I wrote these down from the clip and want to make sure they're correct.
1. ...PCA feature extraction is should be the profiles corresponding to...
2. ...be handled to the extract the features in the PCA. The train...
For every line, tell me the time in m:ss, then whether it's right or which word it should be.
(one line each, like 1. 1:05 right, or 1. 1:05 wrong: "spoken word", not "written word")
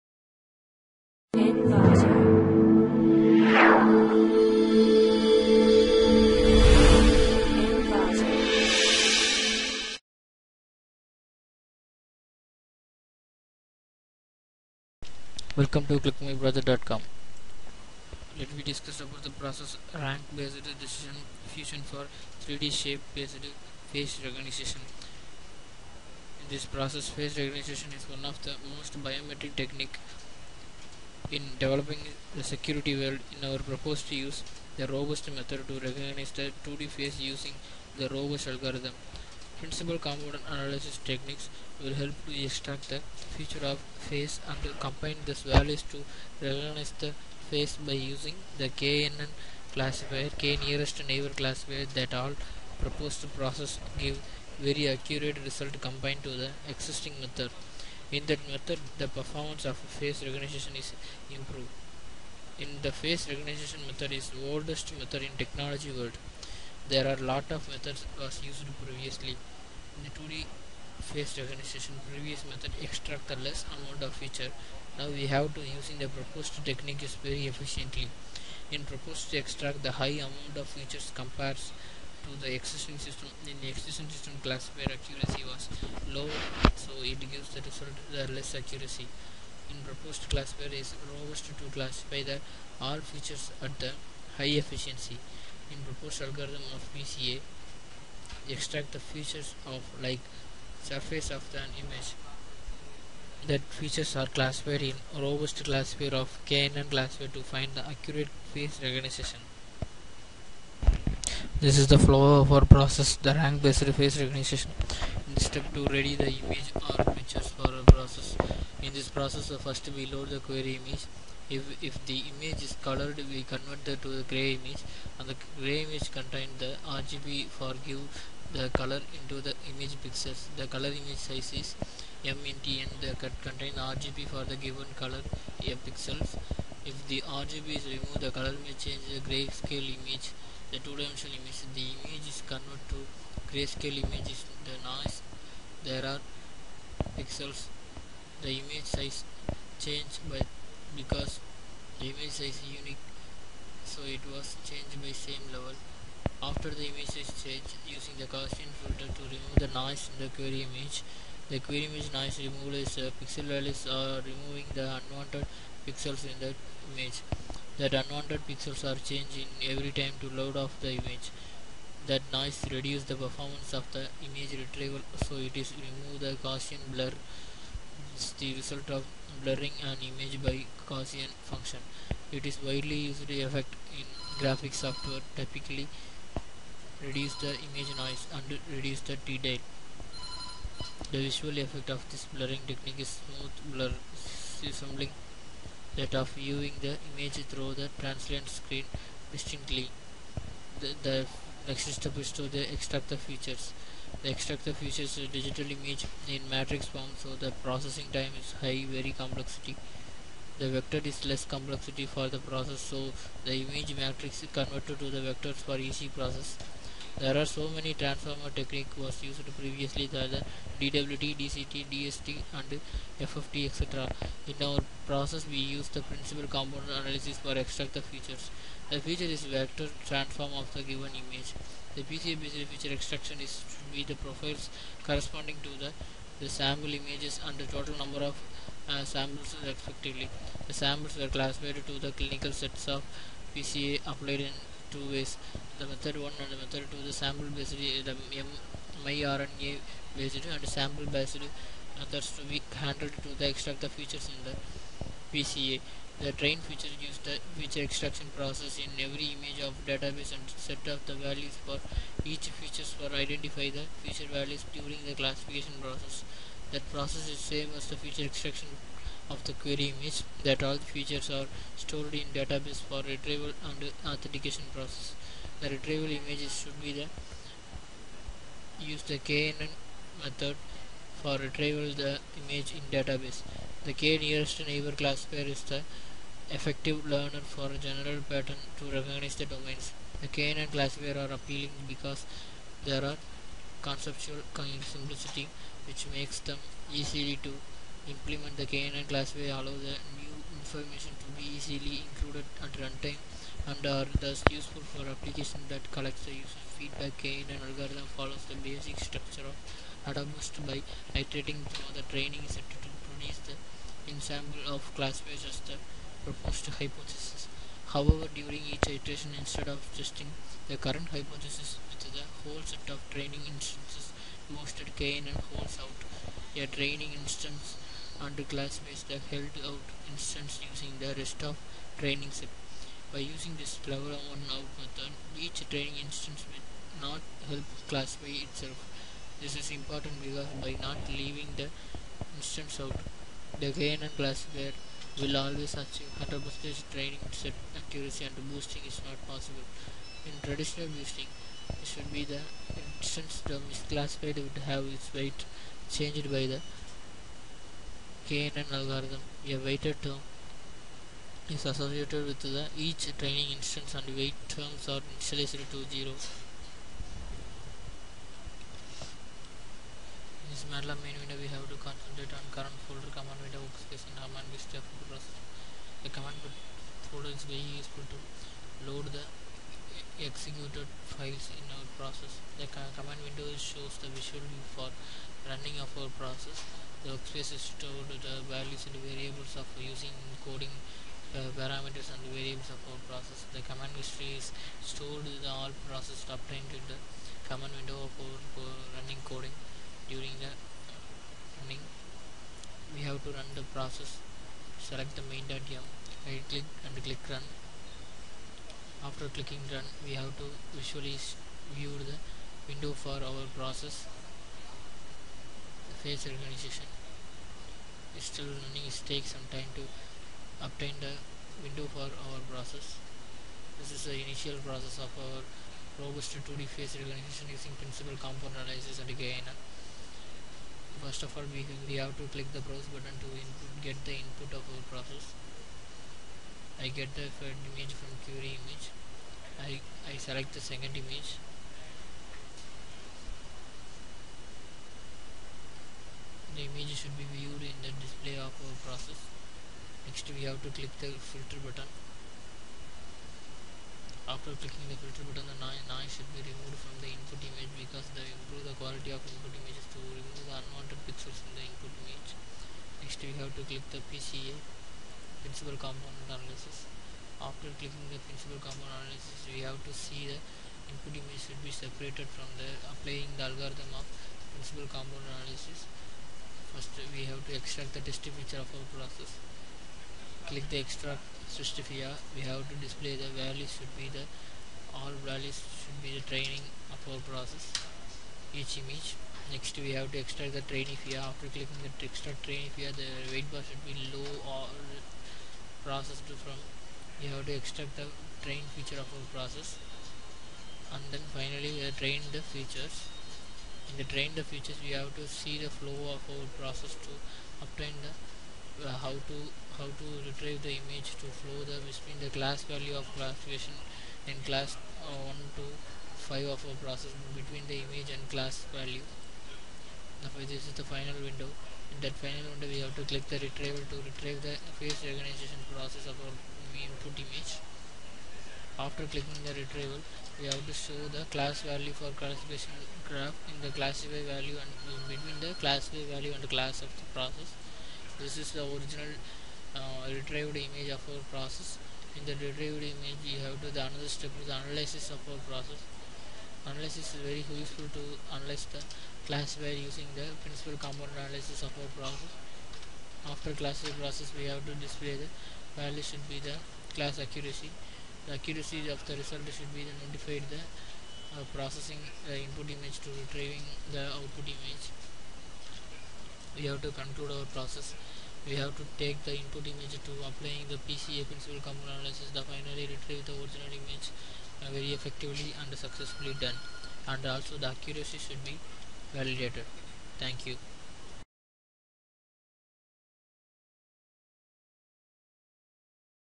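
1. 3:52 right
2. 4:12 right.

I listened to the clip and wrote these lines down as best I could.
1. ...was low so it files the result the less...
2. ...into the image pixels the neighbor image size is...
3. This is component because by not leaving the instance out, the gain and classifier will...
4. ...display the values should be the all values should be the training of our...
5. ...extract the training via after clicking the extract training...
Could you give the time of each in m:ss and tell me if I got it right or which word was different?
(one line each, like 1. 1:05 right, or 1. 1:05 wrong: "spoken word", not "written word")
1. 1:25 wrong: "gives", not "files"
2. 2:09 wrong: "color", not "neighbor"
3. 5:39 wrong: "important", not "component"
4. 8:02 right
5. 8:10 right.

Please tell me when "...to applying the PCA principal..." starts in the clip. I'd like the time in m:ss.
9:30.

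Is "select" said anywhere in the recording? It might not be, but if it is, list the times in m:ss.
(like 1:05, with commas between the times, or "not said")
6:44, 7:20.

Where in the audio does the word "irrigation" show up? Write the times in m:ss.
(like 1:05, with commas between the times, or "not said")
not said.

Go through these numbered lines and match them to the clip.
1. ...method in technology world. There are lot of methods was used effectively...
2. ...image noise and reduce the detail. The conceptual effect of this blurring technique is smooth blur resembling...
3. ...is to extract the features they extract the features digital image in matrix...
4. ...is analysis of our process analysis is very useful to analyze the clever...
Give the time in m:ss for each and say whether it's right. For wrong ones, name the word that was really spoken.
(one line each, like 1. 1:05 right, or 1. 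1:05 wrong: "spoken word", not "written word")
1. 1:04 wrong: "previously", not "effectively"
2. 3:07 wrong: "visual", not "conceptual"
3. 3:22 right
4. 9:04 wrong: "classifier", not "clever".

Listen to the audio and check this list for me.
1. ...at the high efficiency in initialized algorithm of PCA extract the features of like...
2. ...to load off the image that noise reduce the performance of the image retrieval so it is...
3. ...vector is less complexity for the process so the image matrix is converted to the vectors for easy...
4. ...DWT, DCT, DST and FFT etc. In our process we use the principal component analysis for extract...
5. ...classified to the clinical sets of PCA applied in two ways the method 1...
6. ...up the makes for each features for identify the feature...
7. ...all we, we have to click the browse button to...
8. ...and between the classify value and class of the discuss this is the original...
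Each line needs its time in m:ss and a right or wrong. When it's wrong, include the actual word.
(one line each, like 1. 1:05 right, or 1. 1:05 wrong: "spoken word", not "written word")
1. 1:33 wrong: "proposed", not "initialized"
2. 2:50 right
3. 3:30 right
4. 3:40 right
5. 4:01 right
6. 4:20 wrong: "values", not "makes"
7. 7:11 right
8. 8:54 wrong: "process", not "discuss".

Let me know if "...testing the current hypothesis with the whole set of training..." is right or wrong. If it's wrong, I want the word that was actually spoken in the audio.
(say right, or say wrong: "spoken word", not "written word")
right.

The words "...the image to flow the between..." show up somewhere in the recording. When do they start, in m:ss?
8:30.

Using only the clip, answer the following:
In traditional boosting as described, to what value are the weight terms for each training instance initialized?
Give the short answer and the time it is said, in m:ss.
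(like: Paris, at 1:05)
0, at 6:05.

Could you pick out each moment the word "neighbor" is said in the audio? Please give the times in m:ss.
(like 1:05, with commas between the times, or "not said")
0:51, 4:44.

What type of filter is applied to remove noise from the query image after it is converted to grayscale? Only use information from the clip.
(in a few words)
Gaussian filter.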